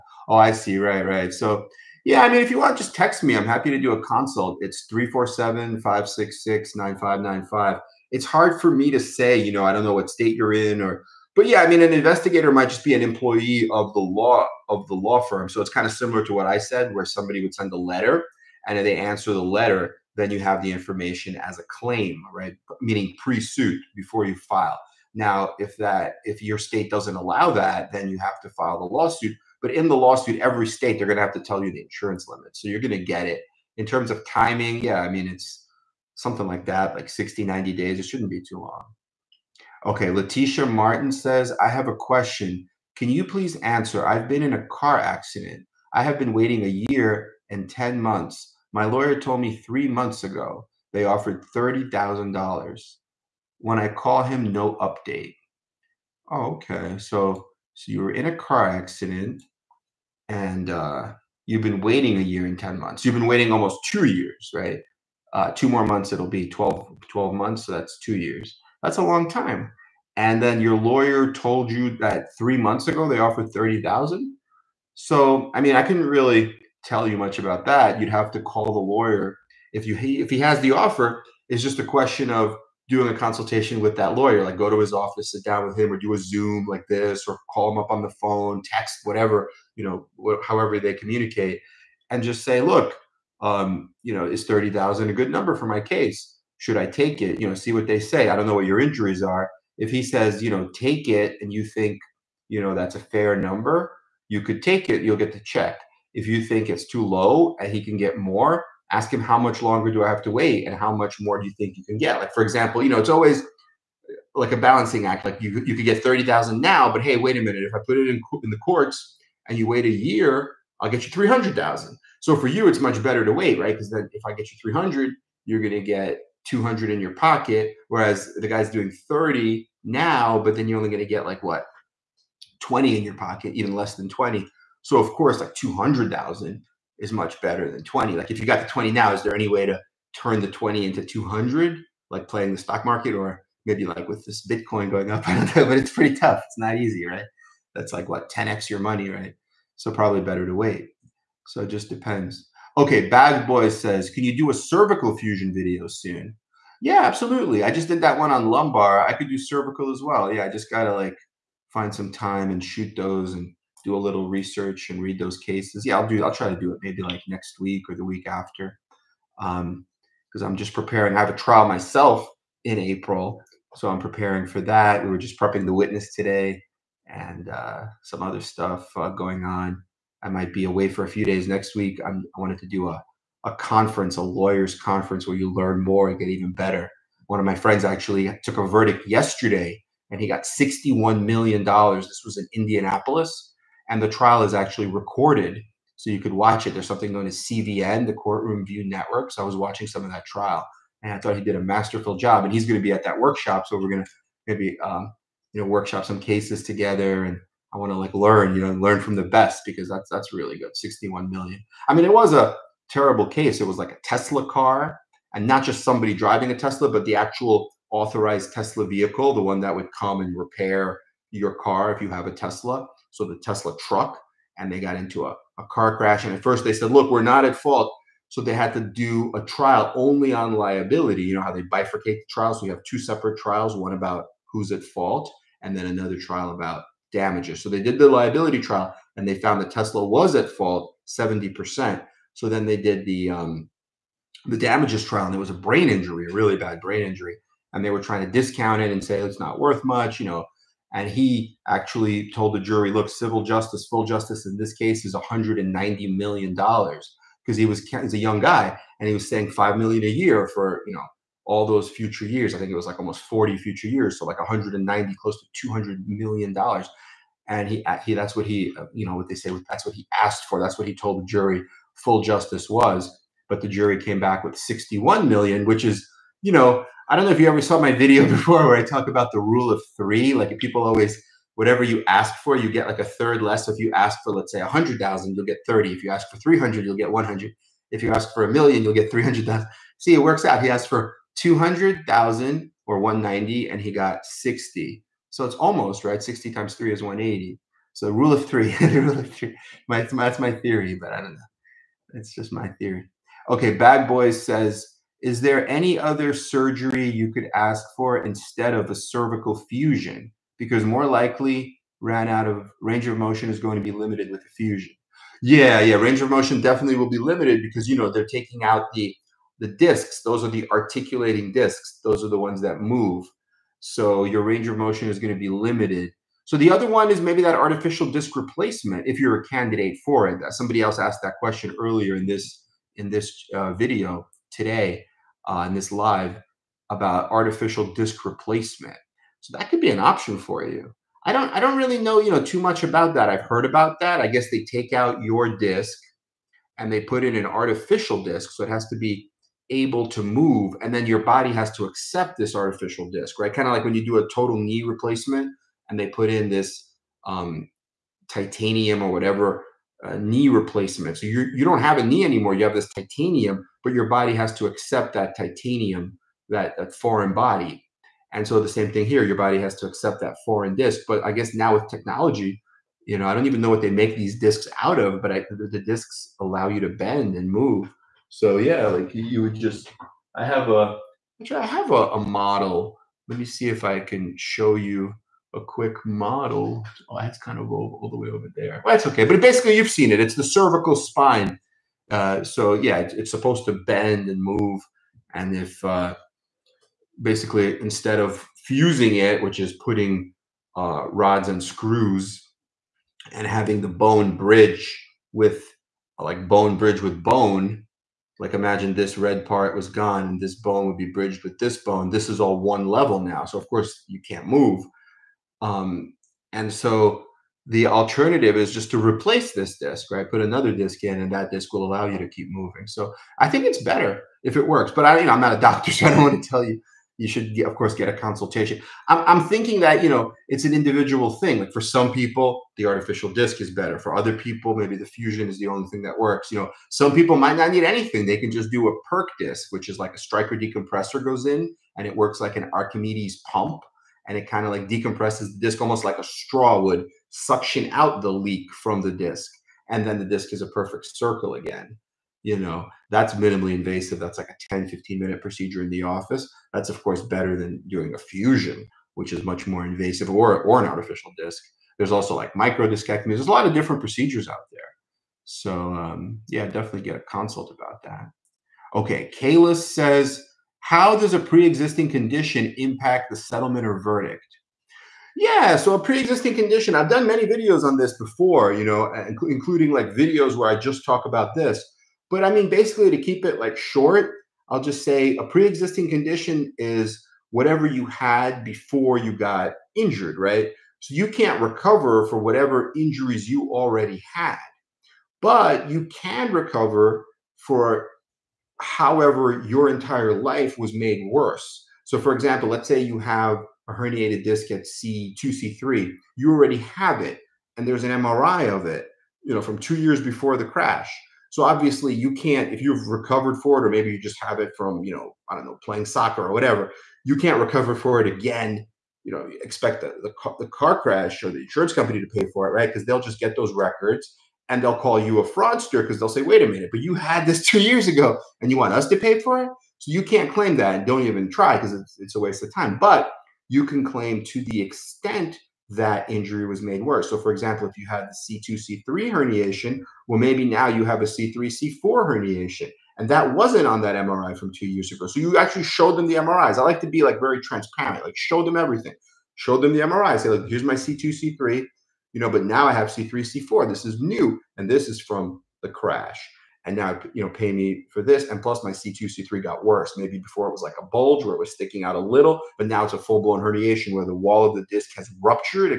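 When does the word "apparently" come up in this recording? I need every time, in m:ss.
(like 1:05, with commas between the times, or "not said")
not said.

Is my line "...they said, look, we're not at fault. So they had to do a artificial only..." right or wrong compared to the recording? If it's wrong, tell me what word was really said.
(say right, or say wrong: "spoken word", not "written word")
wrong: "trial", not "artificial".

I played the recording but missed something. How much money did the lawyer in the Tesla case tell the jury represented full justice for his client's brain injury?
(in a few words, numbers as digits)
$190 million.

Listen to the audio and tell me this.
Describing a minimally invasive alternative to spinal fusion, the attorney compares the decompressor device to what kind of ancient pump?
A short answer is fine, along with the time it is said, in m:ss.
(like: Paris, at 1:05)
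Archimedes pump, at 7:22.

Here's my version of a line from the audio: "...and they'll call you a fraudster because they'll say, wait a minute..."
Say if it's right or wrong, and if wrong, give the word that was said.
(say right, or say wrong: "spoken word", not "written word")
right.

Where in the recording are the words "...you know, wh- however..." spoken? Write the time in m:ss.
1:29.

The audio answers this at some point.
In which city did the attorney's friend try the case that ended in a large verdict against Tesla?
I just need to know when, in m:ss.
3:12.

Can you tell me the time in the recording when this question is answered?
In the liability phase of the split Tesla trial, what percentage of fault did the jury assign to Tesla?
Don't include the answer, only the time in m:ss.
4:01.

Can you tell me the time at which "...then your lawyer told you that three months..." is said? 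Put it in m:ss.
1:10.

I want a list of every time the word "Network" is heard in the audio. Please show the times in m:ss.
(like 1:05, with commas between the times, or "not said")
3:18.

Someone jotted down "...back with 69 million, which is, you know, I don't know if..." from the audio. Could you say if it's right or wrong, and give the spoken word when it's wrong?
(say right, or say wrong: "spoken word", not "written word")
wrong: "61", not "69".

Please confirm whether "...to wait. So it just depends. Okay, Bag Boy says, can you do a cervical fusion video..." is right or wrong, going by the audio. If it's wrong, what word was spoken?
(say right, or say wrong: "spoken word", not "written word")
right.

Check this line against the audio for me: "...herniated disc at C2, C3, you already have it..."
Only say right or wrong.
right.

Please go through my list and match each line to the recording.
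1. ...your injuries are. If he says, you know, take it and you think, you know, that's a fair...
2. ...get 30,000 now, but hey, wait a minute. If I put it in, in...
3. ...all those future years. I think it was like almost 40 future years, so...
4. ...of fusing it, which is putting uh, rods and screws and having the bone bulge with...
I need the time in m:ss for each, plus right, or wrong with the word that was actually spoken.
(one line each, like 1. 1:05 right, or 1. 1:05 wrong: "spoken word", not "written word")
1. 1:38 right
2. 1:55 right
3. 4:21 right
4. 6:38 wrong: "bridge", not "bulge".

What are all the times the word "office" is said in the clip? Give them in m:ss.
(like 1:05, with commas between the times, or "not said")
1:24, 7:36.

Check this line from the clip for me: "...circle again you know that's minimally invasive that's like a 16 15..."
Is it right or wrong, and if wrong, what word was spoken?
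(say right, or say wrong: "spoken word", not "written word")
wrong: "10", not "16".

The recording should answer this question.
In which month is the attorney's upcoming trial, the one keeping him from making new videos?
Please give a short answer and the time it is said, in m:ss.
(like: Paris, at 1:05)
April, at 2:52.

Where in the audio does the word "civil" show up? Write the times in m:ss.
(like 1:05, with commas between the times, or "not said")
4:13.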